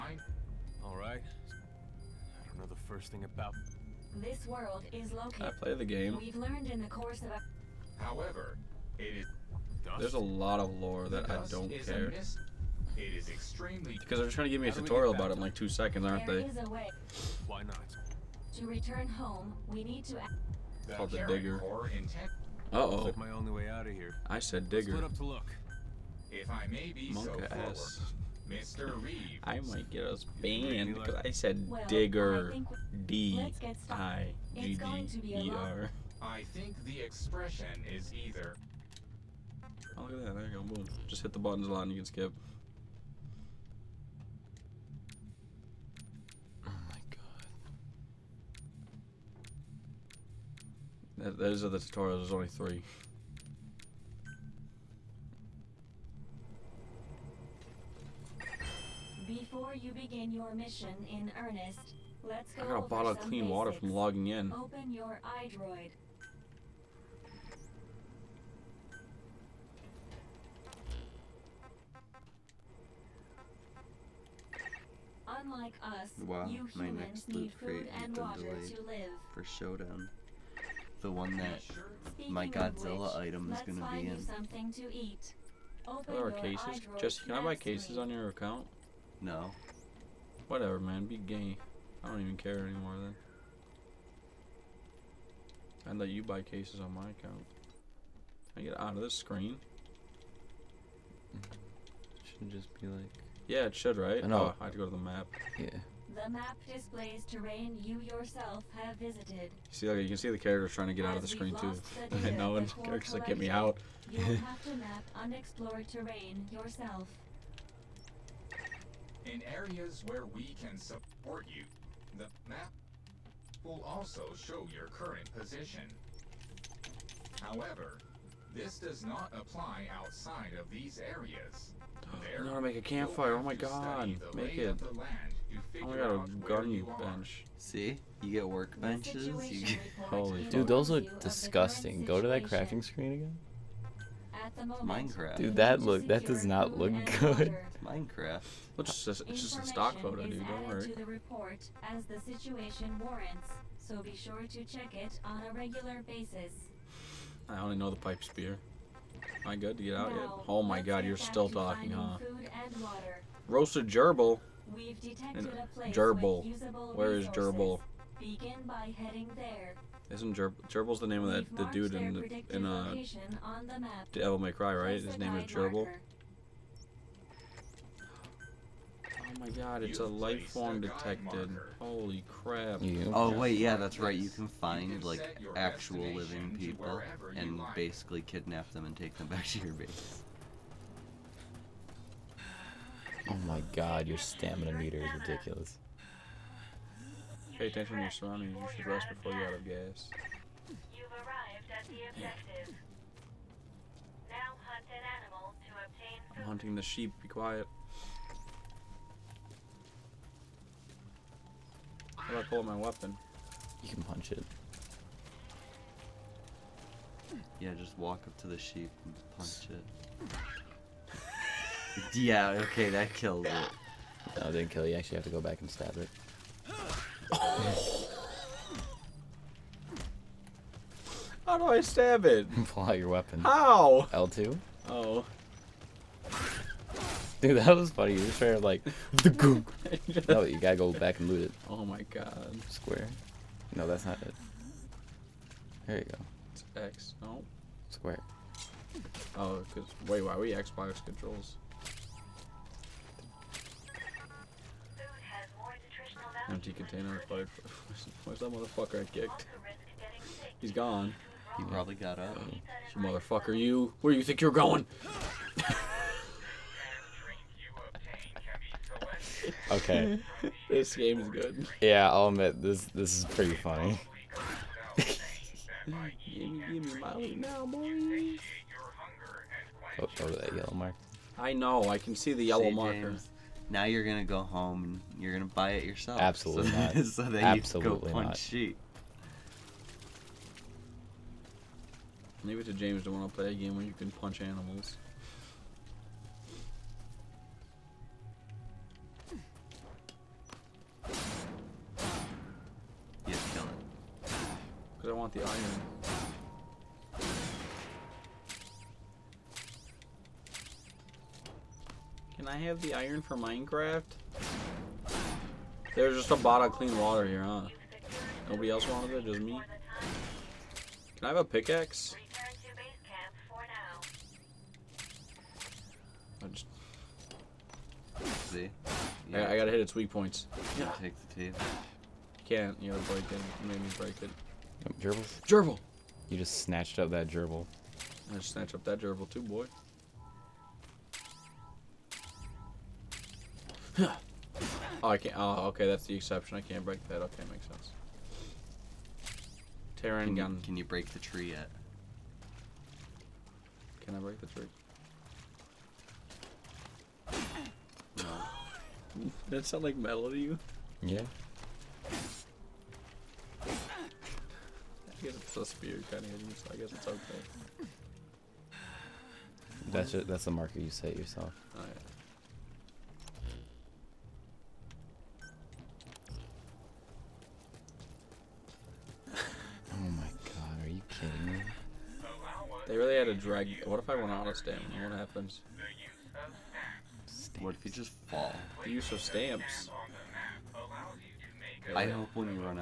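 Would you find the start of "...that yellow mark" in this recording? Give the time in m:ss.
4:40.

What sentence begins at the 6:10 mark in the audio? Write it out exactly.
that's the marker you set yourself.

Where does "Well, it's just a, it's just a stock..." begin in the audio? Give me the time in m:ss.
2:28.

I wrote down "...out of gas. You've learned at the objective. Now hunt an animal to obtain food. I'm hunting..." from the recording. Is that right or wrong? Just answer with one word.
wrong.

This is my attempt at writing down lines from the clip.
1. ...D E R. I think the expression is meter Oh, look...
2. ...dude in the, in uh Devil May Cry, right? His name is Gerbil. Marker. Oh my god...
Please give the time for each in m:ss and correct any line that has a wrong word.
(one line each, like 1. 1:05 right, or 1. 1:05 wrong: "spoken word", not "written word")
1. 0:34 wrong: "either", not "meter"
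2. 2:51 right.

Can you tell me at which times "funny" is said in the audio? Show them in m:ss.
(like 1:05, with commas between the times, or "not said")
3:57, 4:33.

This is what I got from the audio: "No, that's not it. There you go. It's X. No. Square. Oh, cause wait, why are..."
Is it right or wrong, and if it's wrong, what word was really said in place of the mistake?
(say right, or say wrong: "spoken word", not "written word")
right.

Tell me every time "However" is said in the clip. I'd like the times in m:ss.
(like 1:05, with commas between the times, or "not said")
0:08, 2:07.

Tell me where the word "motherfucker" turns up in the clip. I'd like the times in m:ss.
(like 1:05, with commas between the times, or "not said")
4:18, 4:23.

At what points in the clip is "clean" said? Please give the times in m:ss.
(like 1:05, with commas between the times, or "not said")
1:03, 5:16.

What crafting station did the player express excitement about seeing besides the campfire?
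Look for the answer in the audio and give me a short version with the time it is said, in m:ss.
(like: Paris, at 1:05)
gardening bench, at 2:16.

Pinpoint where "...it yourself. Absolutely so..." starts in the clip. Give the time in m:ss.
4:45.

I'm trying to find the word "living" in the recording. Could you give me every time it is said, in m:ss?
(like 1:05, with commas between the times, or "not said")
3:06.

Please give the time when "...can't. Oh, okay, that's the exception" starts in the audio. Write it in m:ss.
5:45.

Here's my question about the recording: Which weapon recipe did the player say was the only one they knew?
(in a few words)
pipe spear.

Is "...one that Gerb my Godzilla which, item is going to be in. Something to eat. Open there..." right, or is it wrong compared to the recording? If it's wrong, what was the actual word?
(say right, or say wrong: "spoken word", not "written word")
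wrong: "Speaking", not "Gerb".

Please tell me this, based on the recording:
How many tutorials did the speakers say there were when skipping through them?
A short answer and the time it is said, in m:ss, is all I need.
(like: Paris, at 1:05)
3, at 0:52.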